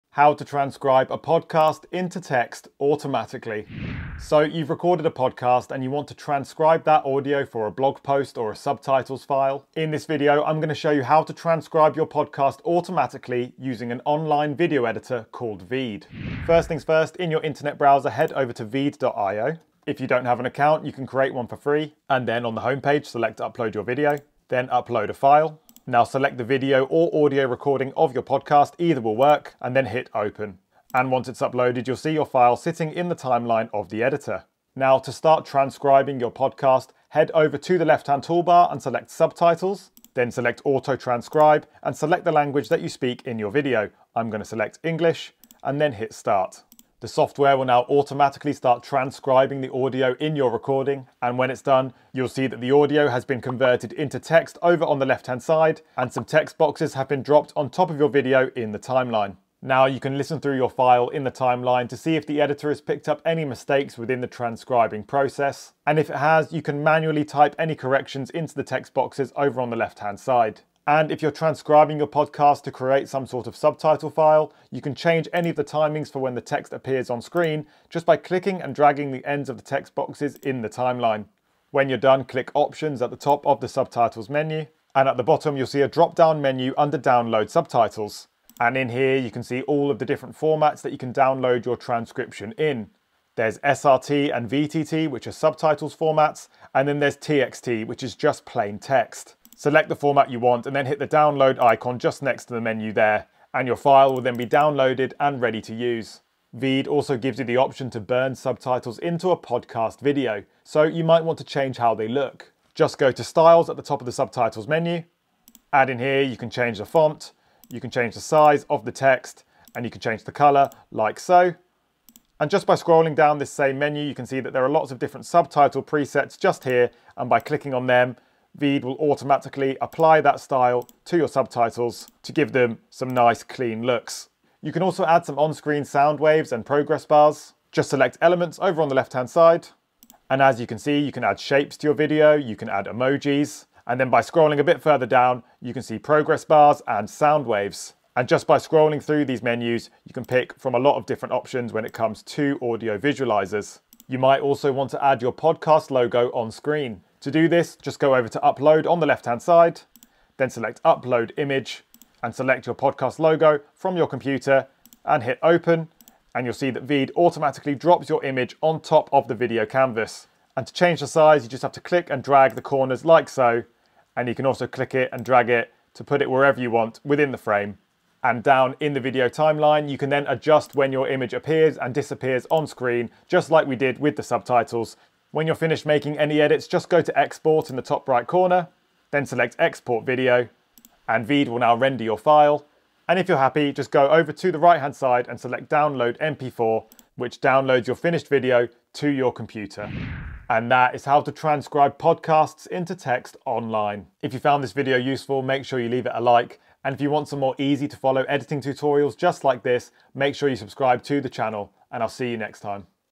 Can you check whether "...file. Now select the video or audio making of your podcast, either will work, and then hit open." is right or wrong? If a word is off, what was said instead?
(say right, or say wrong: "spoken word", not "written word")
wrong: "recording", not "making".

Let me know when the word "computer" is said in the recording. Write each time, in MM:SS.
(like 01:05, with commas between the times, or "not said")
02:44, 03:19.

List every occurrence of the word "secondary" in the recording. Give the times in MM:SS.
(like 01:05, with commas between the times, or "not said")
not said.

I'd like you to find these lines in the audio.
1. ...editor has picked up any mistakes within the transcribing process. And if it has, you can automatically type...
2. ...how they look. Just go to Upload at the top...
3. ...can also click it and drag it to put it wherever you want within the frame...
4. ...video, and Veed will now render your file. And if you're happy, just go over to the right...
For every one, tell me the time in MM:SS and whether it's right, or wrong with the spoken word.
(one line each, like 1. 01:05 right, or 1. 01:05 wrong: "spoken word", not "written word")
1. 01:02 wrong: "manually", not "automatically"
2. 01:51 wrong: "Styles", not "Upload"
3. 02:54 right
4. 03:10 right.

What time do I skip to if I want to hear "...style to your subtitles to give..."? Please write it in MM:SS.
02:10.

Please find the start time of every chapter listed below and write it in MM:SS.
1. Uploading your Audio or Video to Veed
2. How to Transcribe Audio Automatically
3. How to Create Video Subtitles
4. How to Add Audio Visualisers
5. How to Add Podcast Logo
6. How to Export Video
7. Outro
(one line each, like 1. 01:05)
1. 00:16
2. 00:34
3. 01:46
4. 02:14
5. 02:33
6. 03:05
7. 03:20.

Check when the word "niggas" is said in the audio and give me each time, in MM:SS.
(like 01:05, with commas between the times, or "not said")
not said.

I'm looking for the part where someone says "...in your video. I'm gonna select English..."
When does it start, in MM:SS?
00:43.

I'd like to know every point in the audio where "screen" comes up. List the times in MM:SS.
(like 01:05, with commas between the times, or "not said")
01:17, 02:15, 02:36, 03:02.